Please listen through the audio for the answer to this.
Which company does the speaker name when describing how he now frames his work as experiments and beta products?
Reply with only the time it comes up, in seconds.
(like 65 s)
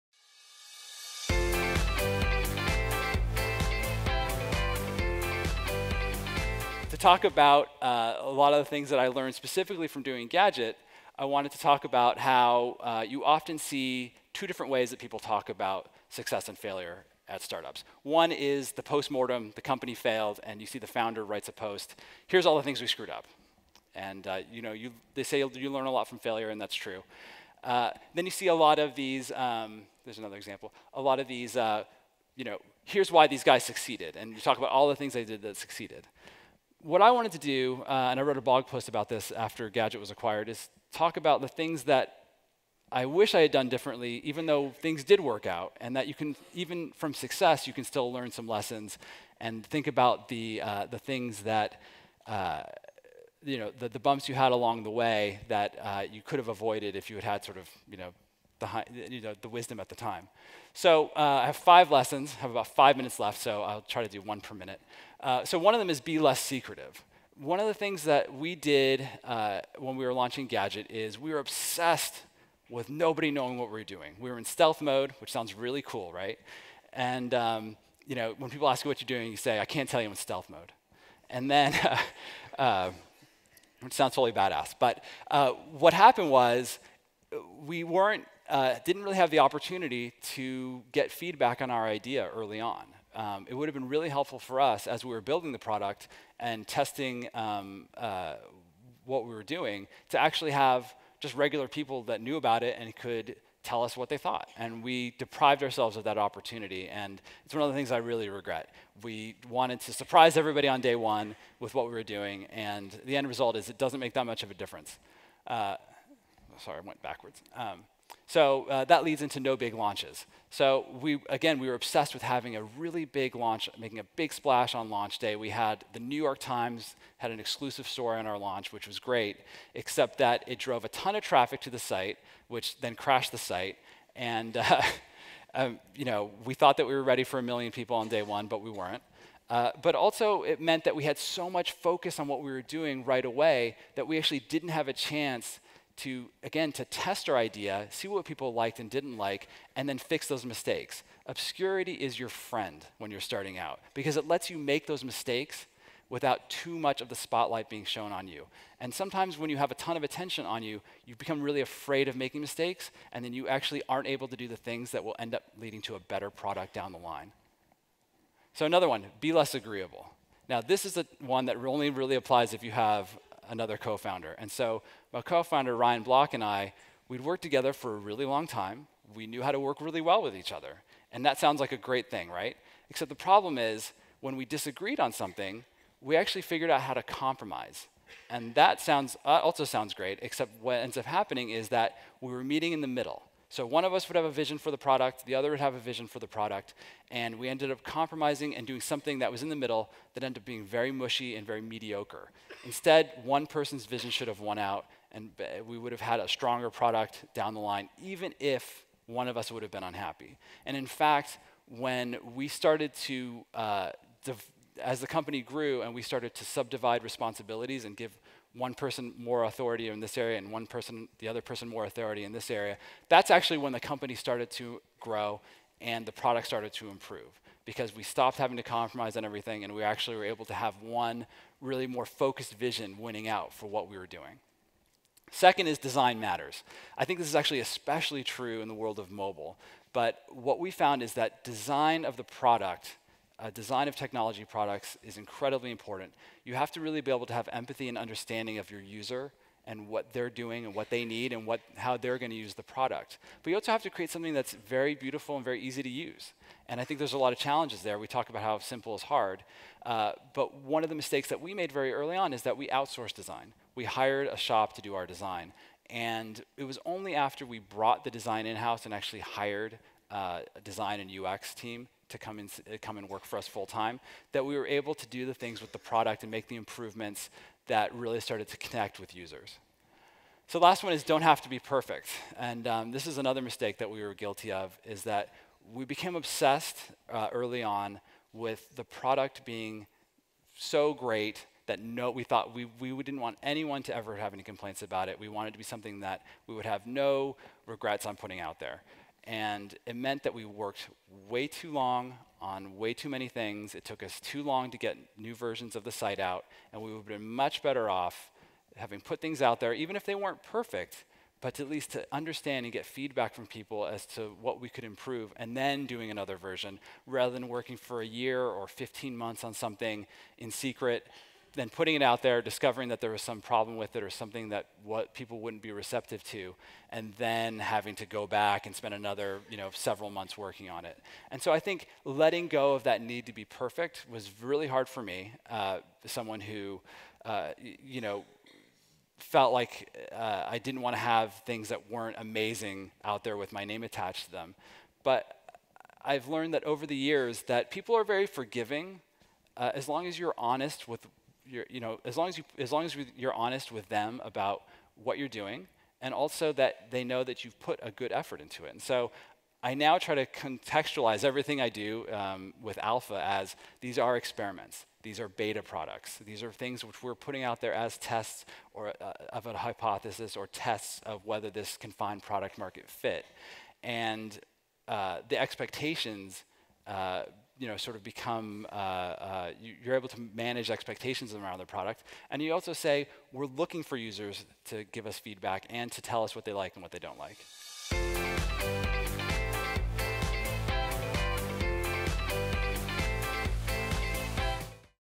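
362 s.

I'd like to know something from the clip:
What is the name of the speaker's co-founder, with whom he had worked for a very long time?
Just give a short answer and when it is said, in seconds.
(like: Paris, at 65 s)
Ryan Block, at 175 s.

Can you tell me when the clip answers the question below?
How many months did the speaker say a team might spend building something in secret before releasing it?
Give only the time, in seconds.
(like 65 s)
318 s.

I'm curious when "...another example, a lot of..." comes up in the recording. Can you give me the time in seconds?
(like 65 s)
30 s.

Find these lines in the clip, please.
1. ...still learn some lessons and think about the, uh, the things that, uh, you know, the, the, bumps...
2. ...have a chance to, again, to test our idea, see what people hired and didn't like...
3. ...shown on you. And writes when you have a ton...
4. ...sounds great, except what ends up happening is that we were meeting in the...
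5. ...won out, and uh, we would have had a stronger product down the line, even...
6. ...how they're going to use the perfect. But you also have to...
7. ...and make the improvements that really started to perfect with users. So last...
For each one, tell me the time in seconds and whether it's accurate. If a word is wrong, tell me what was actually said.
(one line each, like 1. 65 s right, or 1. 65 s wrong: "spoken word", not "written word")
1. 47 s right
2. 144 s wrong: "liked", not "hired"
3. 157 s wrong: "sometimes", not "writes"
4. 189 s right
5. 204 s right
6. 251 s wrong: "product", not "perfect"
7. 276 s wrong: "connect", not "perfect".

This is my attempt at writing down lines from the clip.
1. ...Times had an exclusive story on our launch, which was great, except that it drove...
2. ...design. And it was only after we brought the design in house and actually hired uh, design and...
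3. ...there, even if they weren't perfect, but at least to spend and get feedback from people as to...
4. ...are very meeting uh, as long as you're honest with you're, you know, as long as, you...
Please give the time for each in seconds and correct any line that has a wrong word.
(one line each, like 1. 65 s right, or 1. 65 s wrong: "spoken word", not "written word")
1. 126 s right
2. 265 s right
3. 309 s wrong: "understand", not "spend"
4. 347 s wrong: "forgiving", not "meeting".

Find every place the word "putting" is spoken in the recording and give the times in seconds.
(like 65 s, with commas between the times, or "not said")
298 s, 321 s, 367 s.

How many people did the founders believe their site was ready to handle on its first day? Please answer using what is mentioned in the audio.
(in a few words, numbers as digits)
1 million.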